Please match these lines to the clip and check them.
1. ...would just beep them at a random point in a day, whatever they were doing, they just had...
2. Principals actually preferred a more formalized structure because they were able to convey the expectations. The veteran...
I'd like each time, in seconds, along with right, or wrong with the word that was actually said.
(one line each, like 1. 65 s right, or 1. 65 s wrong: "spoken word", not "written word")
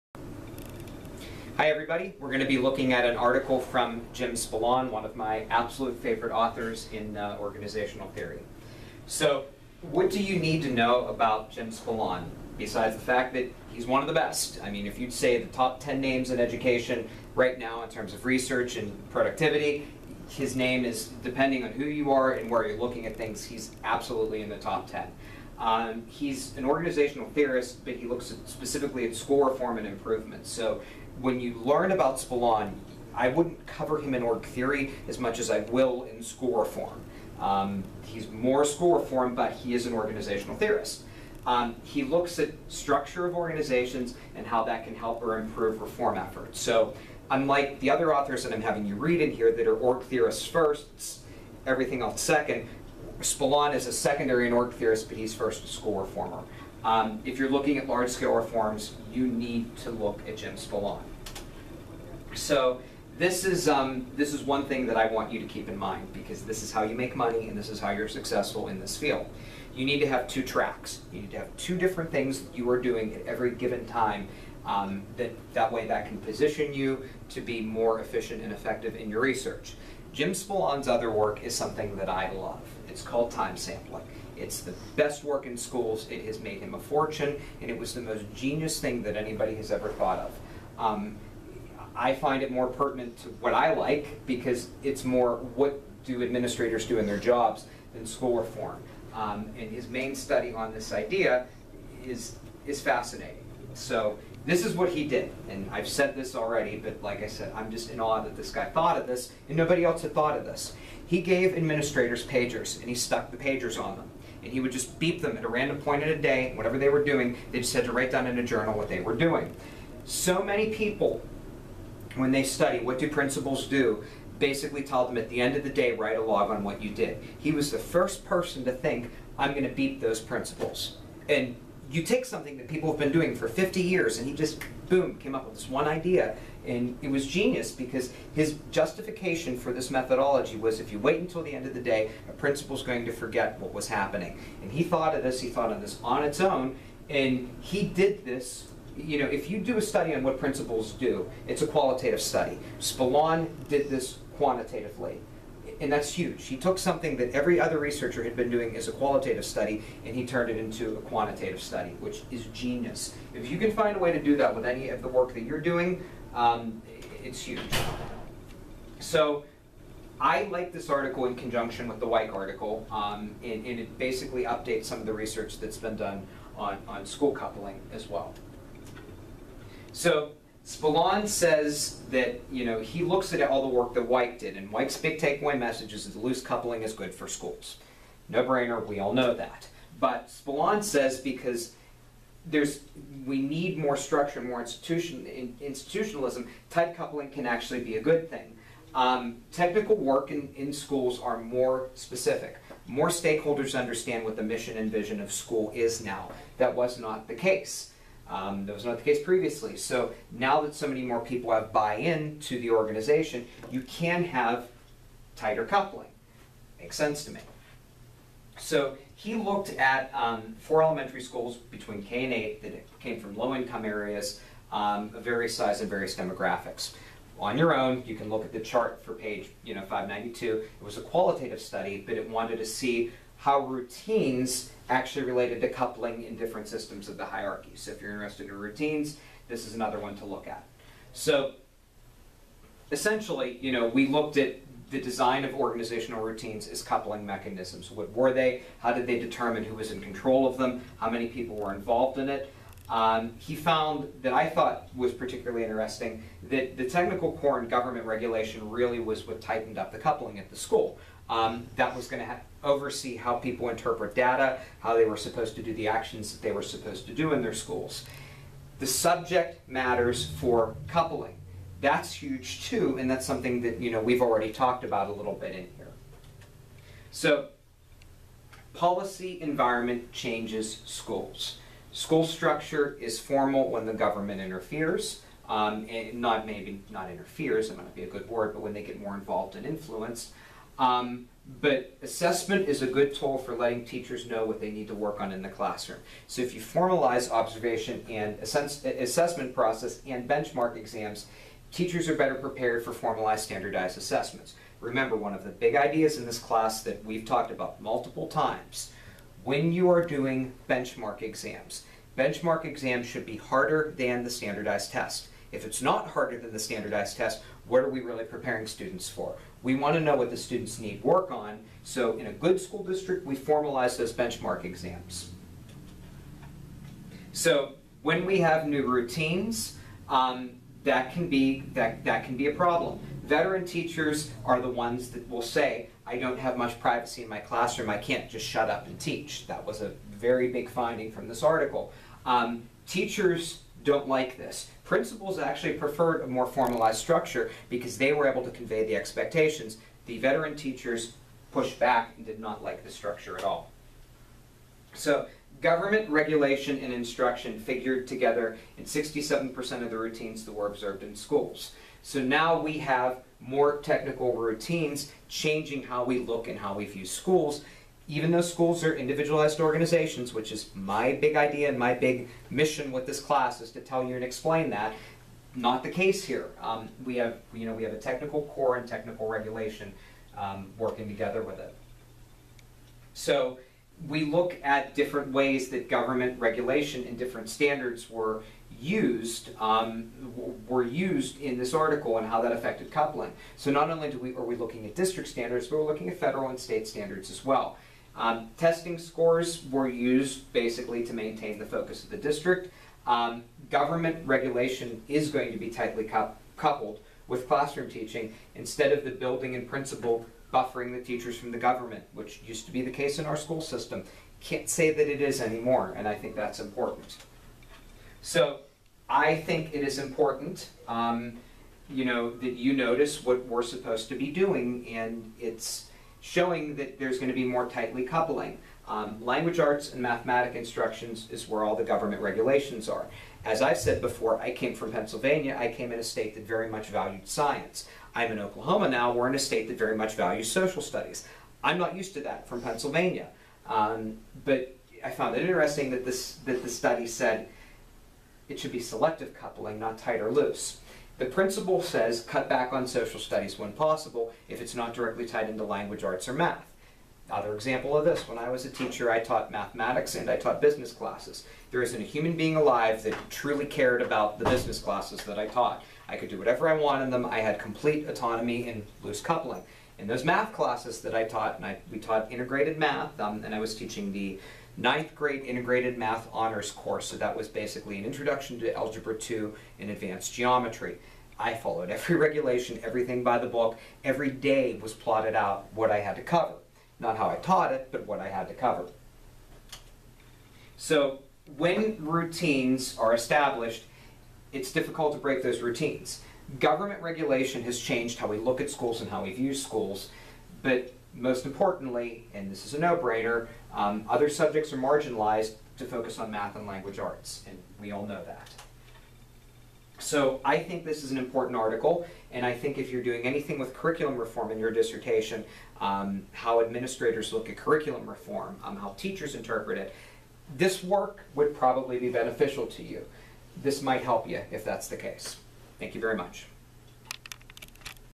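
1. 114 s right
2. 344 s right.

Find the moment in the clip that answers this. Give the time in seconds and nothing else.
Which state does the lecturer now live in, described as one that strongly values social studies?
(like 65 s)
438 s.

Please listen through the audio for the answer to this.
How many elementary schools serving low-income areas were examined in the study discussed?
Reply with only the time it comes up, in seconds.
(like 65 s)
220 s.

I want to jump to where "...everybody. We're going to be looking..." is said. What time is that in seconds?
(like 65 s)
1 s.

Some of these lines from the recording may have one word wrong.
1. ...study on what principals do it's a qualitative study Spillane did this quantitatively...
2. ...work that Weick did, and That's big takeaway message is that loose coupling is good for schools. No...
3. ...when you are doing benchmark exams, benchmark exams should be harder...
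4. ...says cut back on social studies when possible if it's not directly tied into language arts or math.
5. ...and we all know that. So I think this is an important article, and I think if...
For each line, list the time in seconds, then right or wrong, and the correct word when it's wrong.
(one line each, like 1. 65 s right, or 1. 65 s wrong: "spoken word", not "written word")
1. 149 s right
2. 183 s wrong: "Weick", not "That"
3. 309 s right
4. 451 s right
5. 507 s right.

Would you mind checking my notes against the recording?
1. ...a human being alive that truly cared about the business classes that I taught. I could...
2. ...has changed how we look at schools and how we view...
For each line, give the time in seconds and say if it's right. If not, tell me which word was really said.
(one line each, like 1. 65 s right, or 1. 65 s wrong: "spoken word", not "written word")
1. 462 s right
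2. 497 s right.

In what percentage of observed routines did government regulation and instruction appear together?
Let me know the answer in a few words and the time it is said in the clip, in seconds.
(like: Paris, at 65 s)
67%, at 358 s.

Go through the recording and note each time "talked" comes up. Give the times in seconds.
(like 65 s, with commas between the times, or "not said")
274 s, 307 s.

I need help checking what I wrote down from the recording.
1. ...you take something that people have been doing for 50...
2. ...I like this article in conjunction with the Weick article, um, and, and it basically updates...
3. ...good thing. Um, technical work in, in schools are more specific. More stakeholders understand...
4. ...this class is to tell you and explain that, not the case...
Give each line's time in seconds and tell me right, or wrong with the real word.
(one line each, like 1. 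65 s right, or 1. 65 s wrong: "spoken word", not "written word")
1. 131 s right
2. 170 s right
3. 198 s right
4. 373 s right.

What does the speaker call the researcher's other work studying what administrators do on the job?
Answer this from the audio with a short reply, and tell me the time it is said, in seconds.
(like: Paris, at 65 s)
Time sampling, at 83 s.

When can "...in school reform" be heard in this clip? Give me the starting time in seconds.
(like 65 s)
36 s.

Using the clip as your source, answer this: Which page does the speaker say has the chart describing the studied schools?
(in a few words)
592.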